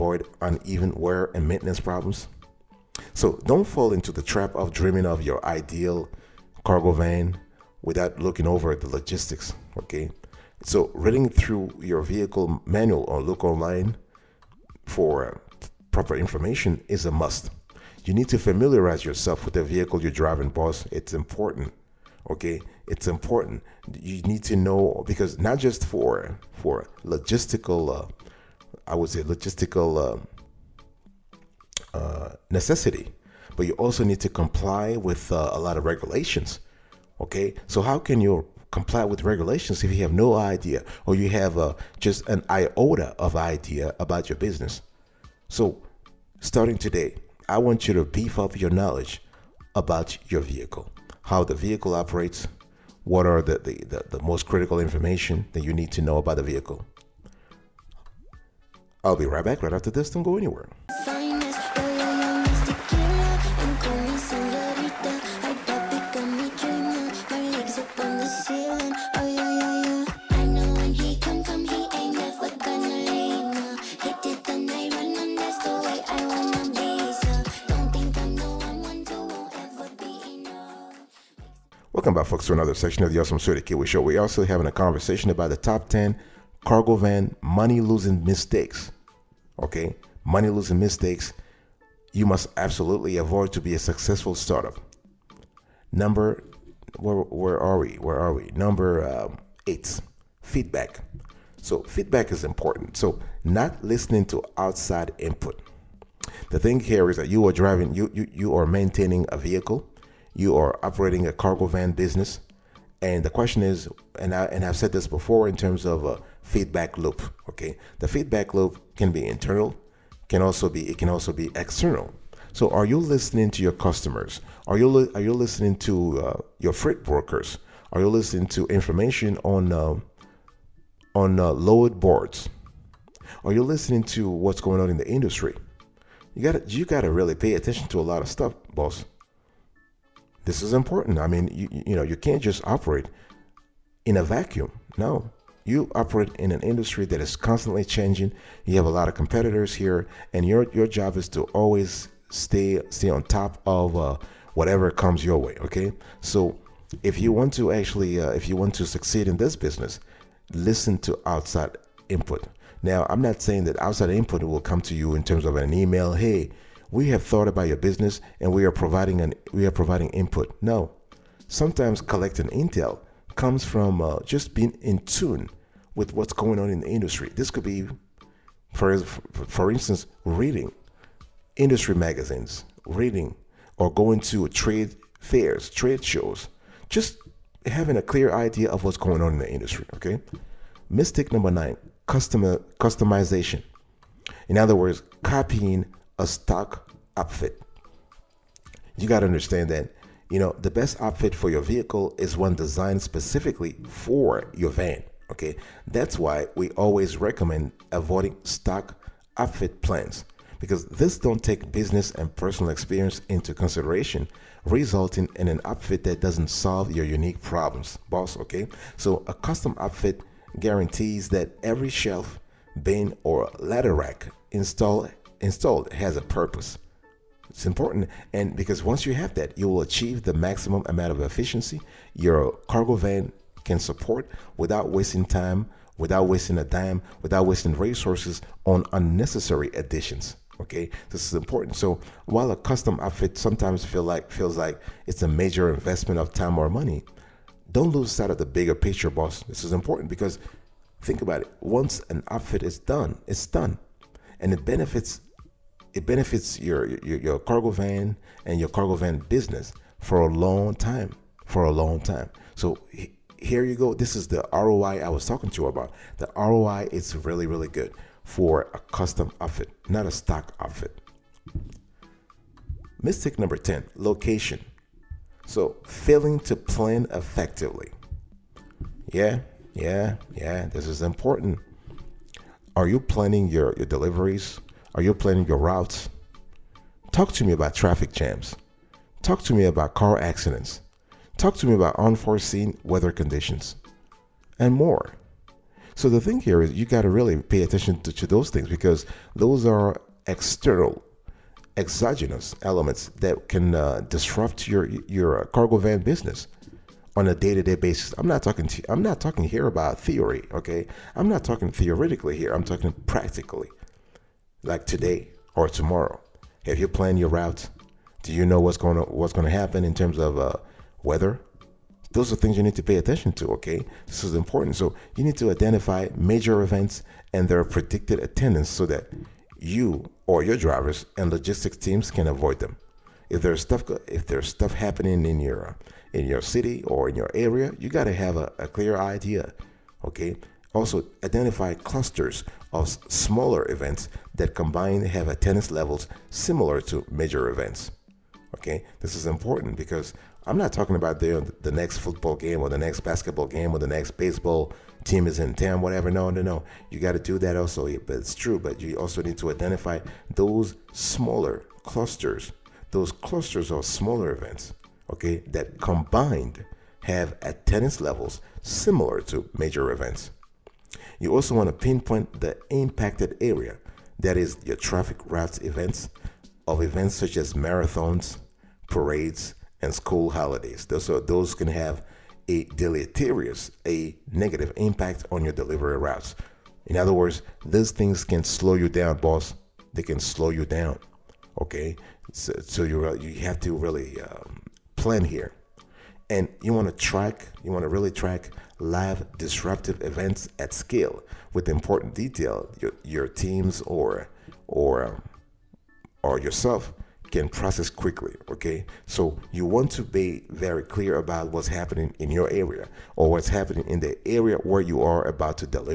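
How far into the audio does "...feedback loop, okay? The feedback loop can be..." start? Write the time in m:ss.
1:56.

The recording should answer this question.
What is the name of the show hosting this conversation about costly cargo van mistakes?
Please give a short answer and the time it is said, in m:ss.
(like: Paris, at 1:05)
Awesome S'witty Kiwi Show, at 1:23.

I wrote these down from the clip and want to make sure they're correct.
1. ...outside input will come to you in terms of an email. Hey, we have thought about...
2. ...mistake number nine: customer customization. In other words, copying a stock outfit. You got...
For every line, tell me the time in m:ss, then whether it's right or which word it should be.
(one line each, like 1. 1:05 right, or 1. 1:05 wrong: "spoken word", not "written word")
1. 2:43 right
2. 3:10 right.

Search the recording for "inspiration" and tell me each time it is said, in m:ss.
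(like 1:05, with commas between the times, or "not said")
not said.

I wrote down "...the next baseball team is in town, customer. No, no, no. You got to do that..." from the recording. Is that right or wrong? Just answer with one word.
wrong.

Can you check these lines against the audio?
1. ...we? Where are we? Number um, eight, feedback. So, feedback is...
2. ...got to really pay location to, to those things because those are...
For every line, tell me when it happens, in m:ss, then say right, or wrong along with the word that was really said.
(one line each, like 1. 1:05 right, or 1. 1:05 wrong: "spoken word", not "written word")
1. 1:37 right
2. 4:56 wrong: "attention", not "location".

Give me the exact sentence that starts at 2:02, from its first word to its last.
So are you listening to your customers?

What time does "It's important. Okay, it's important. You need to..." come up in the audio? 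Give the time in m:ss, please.
0:20.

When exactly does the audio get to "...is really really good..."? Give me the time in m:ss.
4:26.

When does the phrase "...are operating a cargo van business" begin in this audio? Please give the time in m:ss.
1:50.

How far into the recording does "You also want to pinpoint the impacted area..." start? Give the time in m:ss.
6:11.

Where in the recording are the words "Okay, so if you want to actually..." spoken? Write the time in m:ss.
2:35.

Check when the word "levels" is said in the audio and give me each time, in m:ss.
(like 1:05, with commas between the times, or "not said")
5:45, 6:07.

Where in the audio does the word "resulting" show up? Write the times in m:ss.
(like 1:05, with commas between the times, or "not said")
3:34.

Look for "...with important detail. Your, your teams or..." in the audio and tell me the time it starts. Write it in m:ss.
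6:41.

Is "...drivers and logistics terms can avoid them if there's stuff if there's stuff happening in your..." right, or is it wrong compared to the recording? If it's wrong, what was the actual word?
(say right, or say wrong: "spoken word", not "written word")
wrong: "teams", not "terms".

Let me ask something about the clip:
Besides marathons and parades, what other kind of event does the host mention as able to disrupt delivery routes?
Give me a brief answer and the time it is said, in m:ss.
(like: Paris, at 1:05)
School holidays, at 6:19.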